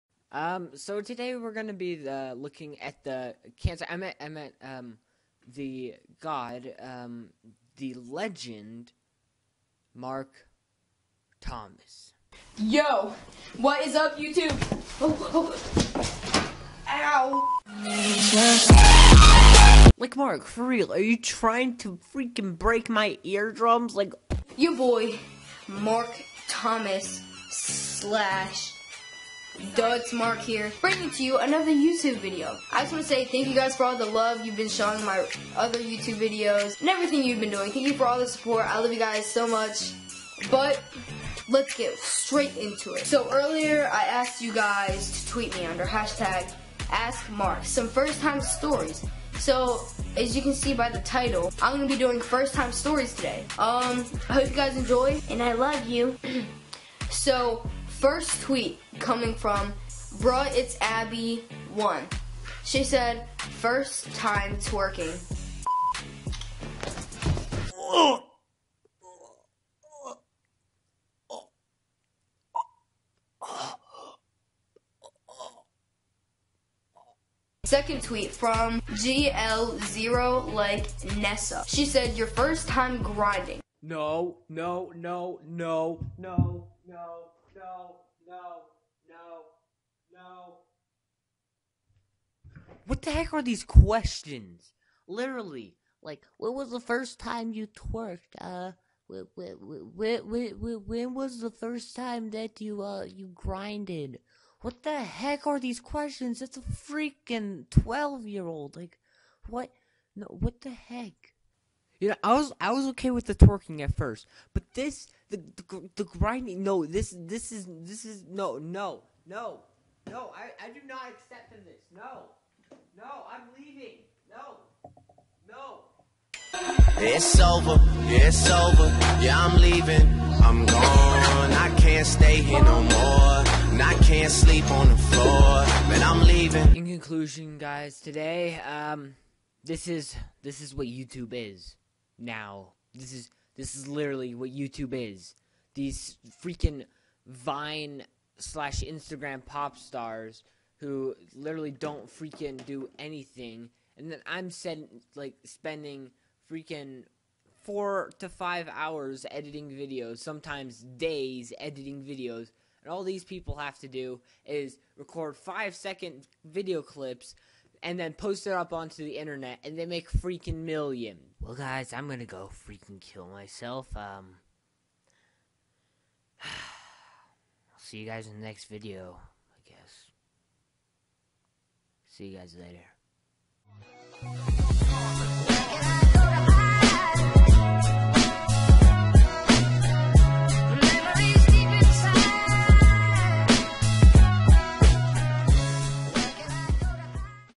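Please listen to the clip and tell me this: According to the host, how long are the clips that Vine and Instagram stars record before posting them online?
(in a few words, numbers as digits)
5 seconds.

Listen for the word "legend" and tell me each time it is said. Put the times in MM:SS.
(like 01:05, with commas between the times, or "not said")
00:07.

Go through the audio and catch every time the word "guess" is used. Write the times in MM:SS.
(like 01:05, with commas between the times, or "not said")
02:59.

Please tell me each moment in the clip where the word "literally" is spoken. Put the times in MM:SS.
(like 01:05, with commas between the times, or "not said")
01:35, 02:23, 02:31.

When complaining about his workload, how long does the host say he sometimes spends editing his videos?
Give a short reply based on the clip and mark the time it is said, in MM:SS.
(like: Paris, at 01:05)
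4 to 5 hours, at 02:37.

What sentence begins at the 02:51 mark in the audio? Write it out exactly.
Well, guys, I'm gonna go freaking kill myself.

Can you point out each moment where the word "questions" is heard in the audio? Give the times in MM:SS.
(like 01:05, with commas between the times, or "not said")
01:33, 01:45.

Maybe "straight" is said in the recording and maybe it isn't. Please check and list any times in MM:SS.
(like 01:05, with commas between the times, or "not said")
00:41.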